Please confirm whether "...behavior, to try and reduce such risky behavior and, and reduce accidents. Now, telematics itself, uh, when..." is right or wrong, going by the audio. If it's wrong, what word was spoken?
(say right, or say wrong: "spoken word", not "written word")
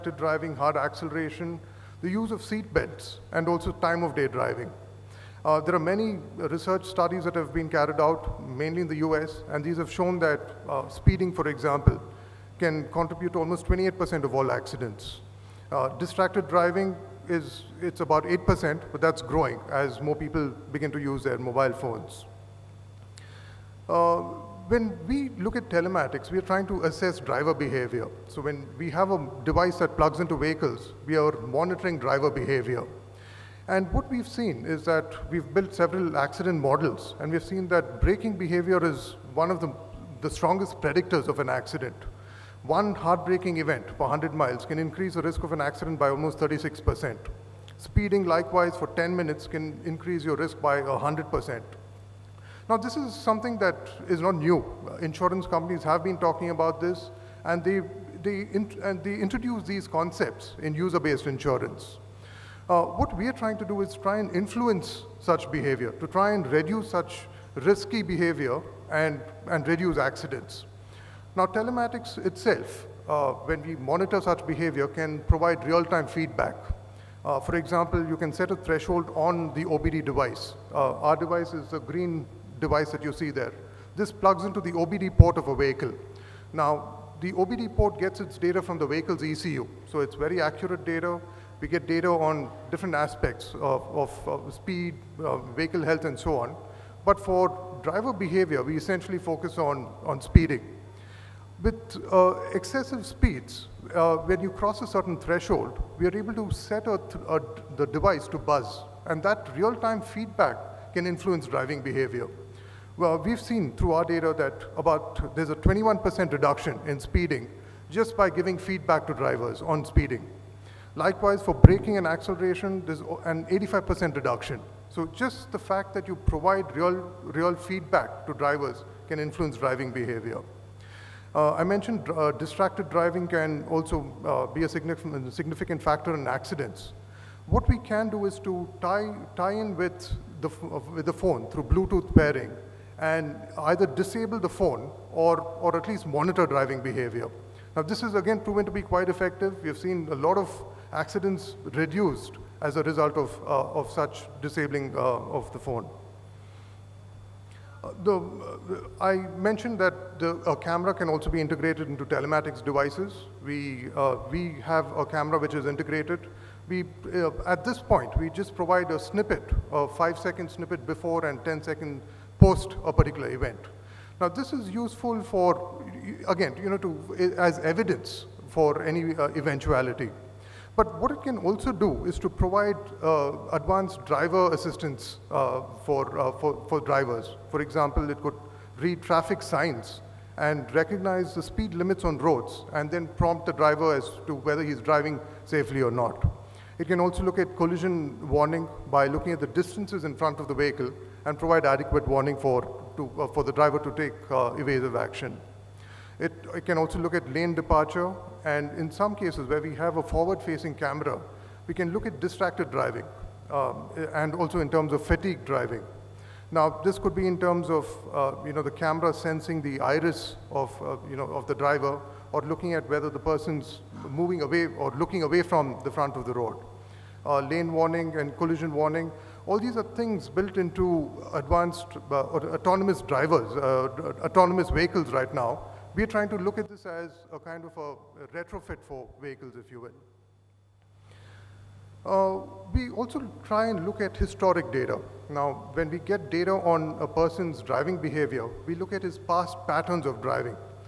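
right.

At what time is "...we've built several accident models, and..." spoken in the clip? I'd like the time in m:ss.
0:35.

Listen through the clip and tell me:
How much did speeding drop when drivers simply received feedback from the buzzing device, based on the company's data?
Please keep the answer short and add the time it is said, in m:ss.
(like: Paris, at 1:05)
21%, at 1:55.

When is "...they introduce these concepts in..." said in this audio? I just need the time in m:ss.
0:59.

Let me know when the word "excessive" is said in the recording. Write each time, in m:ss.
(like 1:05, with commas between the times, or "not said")
1:42.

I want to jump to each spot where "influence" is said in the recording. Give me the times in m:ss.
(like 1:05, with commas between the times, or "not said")
1:04, 1:51, 2:09.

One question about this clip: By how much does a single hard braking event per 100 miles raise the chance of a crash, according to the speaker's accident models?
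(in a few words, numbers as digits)
36%.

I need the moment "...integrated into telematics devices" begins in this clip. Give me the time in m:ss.
2:41.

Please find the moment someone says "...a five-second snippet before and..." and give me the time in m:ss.
2:49.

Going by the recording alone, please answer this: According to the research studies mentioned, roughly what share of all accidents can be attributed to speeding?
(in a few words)
28%.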